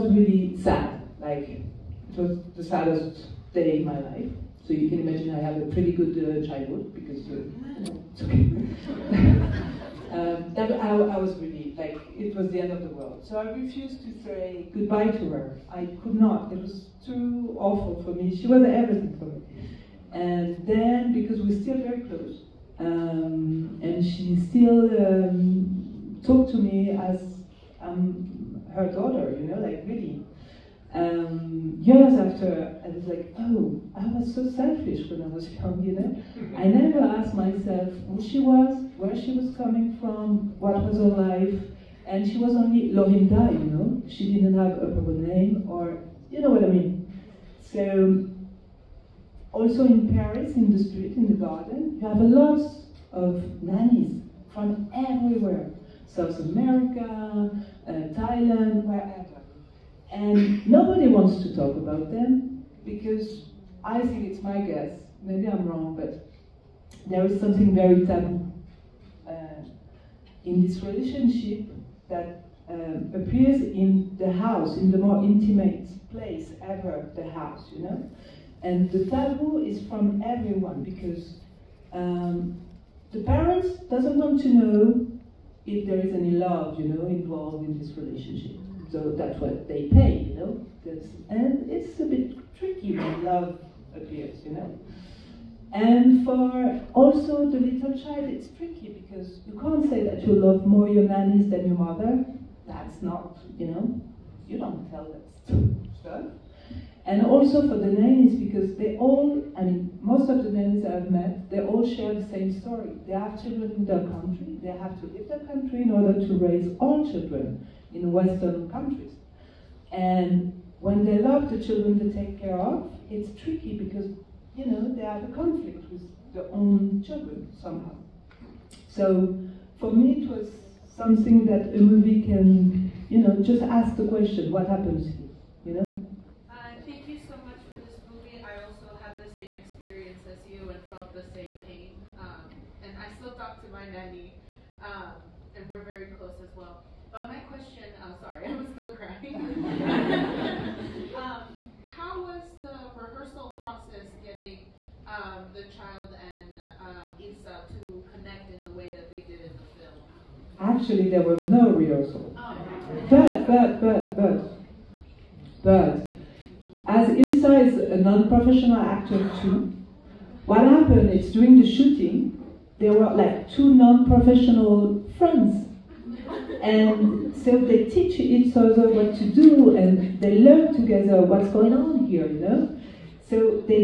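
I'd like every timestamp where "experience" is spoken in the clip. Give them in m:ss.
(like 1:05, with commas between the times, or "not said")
2:19.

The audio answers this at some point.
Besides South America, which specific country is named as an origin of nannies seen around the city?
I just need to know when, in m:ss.
0:58.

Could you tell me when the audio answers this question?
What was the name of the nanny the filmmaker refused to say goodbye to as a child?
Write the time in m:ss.
0:42.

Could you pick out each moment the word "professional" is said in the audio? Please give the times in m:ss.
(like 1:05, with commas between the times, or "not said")
2:47, 2:53.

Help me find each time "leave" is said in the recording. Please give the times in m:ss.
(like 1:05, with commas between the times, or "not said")
1:55.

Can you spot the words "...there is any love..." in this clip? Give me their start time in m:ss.
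1:25.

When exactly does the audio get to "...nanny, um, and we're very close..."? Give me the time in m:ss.
2:23.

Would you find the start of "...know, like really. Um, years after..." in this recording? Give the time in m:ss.
0:29.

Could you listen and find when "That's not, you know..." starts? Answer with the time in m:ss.
1:42.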